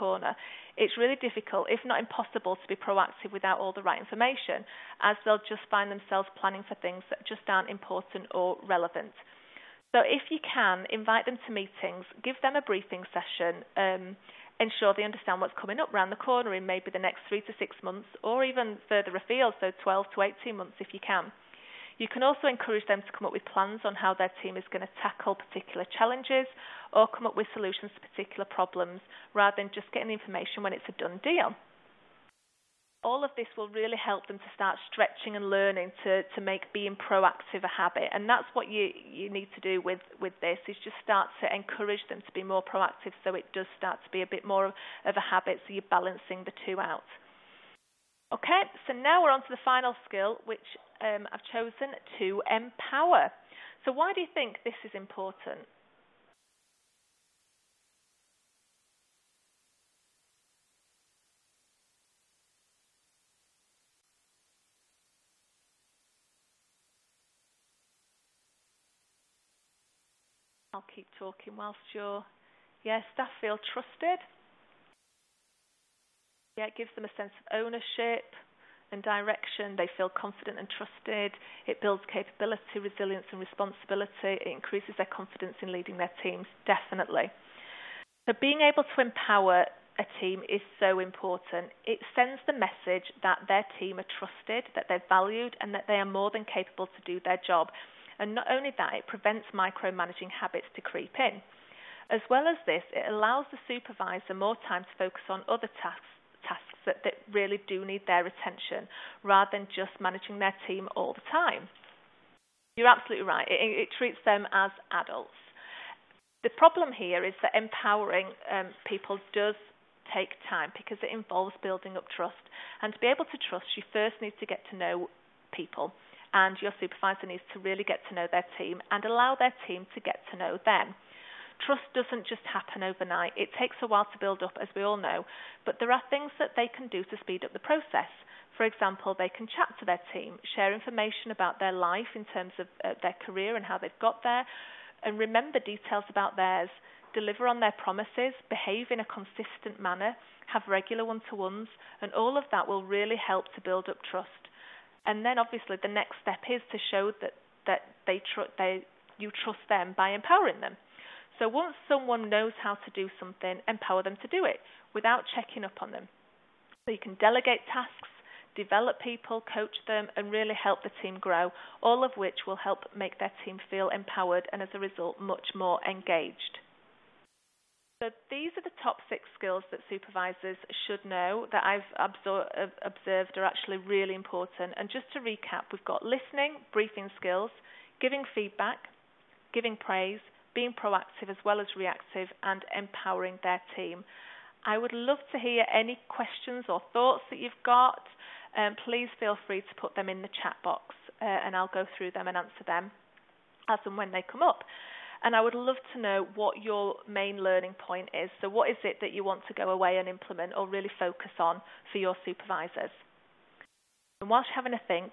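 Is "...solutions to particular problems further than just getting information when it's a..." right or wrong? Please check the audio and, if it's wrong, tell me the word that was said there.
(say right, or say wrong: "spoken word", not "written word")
wrong: "rather", not "further".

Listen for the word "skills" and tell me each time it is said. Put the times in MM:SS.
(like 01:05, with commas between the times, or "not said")
00:50, 02:59, 03:07.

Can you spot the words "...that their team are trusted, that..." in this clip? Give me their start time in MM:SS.
01:33.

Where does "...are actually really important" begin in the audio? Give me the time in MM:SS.
03:03.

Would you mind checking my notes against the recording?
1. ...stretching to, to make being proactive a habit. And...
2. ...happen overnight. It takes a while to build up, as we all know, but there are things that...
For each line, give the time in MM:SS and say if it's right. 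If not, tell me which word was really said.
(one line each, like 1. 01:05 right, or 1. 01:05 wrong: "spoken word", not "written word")
1. 00:35 wrong: "learning", not "stretching"
2. 02:12 right.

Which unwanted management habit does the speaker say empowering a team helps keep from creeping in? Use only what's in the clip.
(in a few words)
Micromanaging.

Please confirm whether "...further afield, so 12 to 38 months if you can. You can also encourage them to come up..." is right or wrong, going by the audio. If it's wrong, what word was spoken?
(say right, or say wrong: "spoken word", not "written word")
wrong: "18", not "38".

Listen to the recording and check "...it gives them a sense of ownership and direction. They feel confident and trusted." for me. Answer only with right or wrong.
right.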